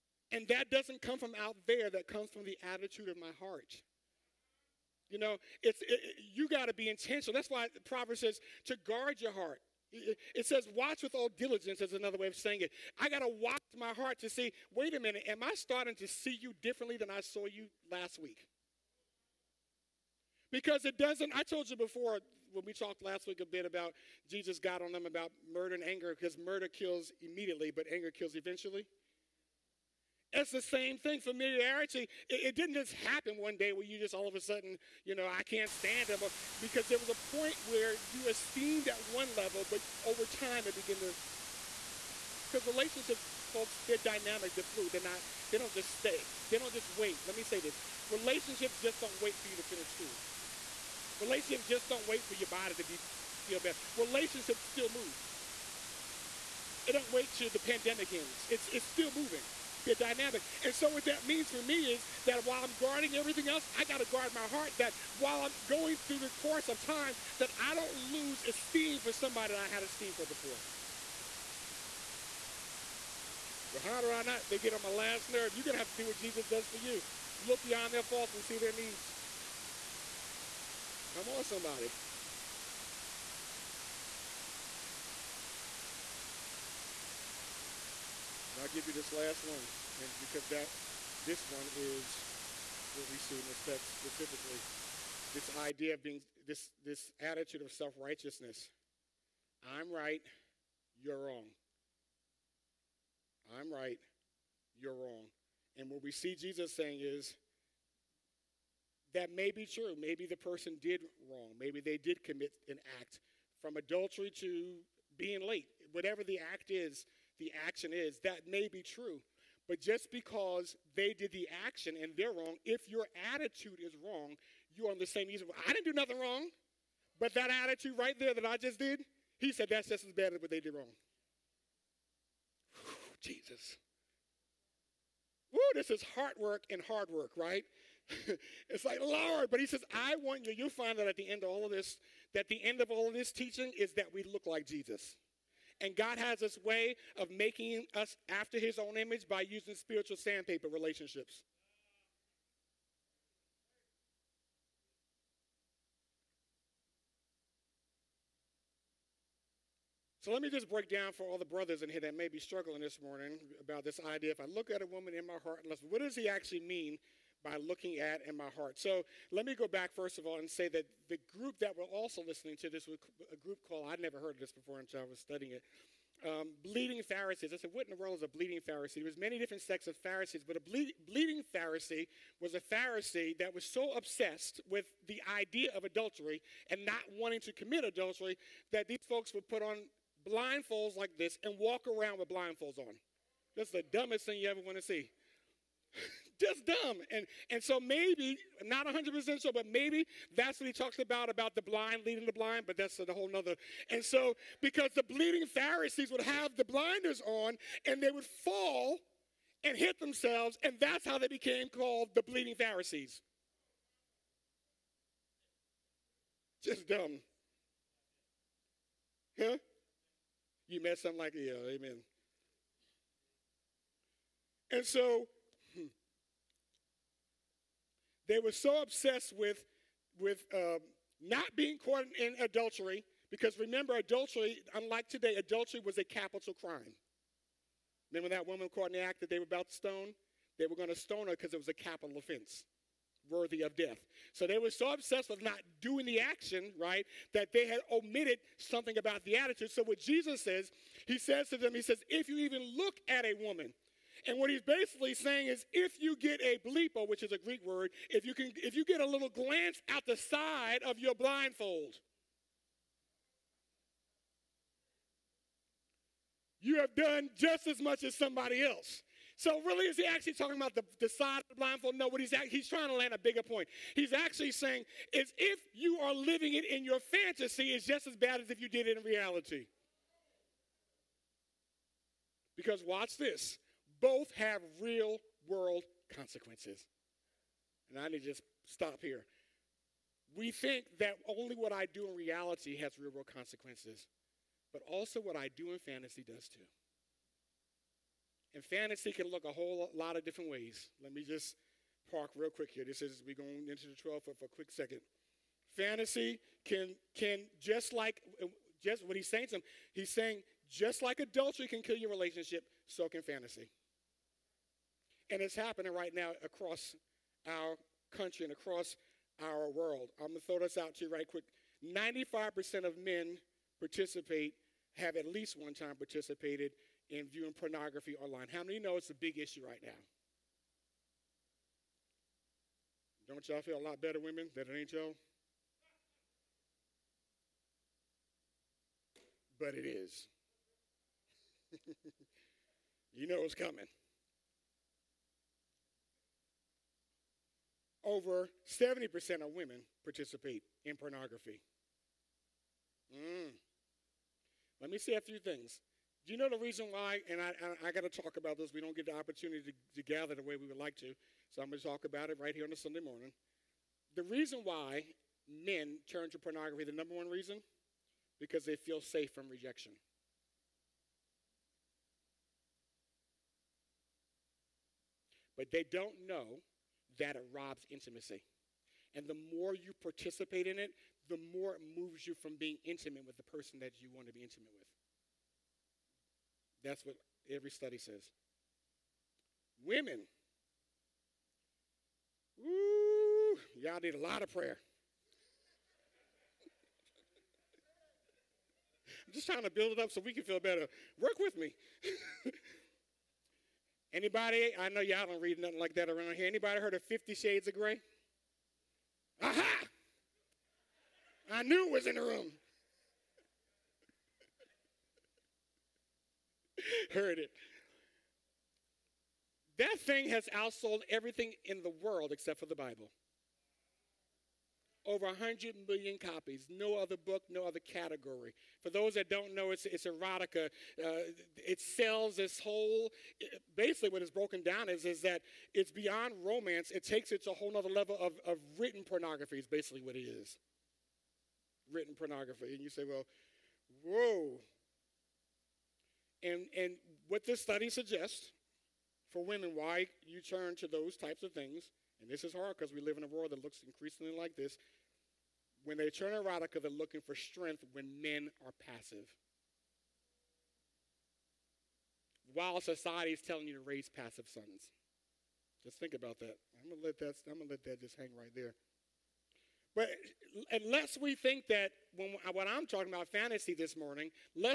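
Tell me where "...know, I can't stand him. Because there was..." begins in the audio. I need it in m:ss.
0:35.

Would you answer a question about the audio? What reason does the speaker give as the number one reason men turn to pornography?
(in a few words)
feel safe from rejection.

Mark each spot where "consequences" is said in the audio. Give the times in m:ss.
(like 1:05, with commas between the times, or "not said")
4:46, 4:53.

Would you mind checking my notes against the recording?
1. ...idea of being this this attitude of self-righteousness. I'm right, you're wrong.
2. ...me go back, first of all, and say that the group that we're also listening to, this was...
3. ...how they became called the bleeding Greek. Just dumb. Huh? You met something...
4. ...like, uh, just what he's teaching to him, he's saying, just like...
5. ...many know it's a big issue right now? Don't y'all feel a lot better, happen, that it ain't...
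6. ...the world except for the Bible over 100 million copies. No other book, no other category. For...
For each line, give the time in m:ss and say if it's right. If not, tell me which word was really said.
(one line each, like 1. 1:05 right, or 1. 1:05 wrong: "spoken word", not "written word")
1. 1:35 right
2. 2:49 right
3. 3:31 wrong: "Pharisees", not "Greek"
4. 5:07 wrong: "saying", not "teaching"
5. 5:28 wrong: "women", not "happen"
6. 7:01 right.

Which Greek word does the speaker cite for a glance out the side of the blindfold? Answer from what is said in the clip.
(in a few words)
blepo.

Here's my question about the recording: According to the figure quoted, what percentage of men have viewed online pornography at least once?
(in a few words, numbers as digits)
95%.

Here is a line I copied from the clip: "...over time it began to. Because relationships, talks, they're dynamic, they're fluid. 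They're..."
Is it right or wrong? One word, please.
wrong.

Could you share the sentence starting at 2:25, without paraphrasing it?
And God has this way of making us after his own image by using spiritual sandpaper relationships.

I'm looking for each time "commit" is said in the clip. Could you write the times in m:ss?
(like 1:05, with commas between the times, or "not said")
1:52, 3:07.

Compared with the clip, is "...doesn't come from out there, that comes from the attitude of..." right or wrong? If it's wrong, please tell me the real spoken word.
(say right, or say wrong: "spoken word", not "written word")
right.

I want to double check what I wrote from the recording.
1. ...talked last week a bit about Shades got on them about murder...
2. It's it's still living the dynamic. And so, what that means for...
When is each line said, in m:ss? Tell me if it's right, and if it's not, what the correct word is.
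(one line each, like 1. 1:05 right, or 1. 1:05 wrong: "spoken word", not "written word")
1. 0:22 wrong: "Jesus", not "Shades"
2. 0:58 wrong: "moving", not "living".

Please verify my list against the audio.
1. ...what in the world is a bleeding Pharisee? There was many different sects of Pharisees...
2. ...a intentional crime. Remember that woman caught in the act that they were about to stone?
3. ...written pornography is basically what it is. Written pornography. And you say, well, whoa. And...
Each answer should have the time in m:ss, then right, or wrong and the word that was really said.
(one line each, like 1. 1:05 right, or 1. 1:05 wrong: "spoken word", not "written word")
1. 2:57 right
2. 3:55 wrong: "capital", not "intentional"
3. 7:18 right.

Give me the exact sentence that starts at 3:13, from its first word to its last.
That's the dumbest thing you ever want to see.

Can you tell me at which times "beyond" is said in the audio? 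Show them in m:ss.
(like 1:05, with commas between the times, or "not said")
1:17, 7:15.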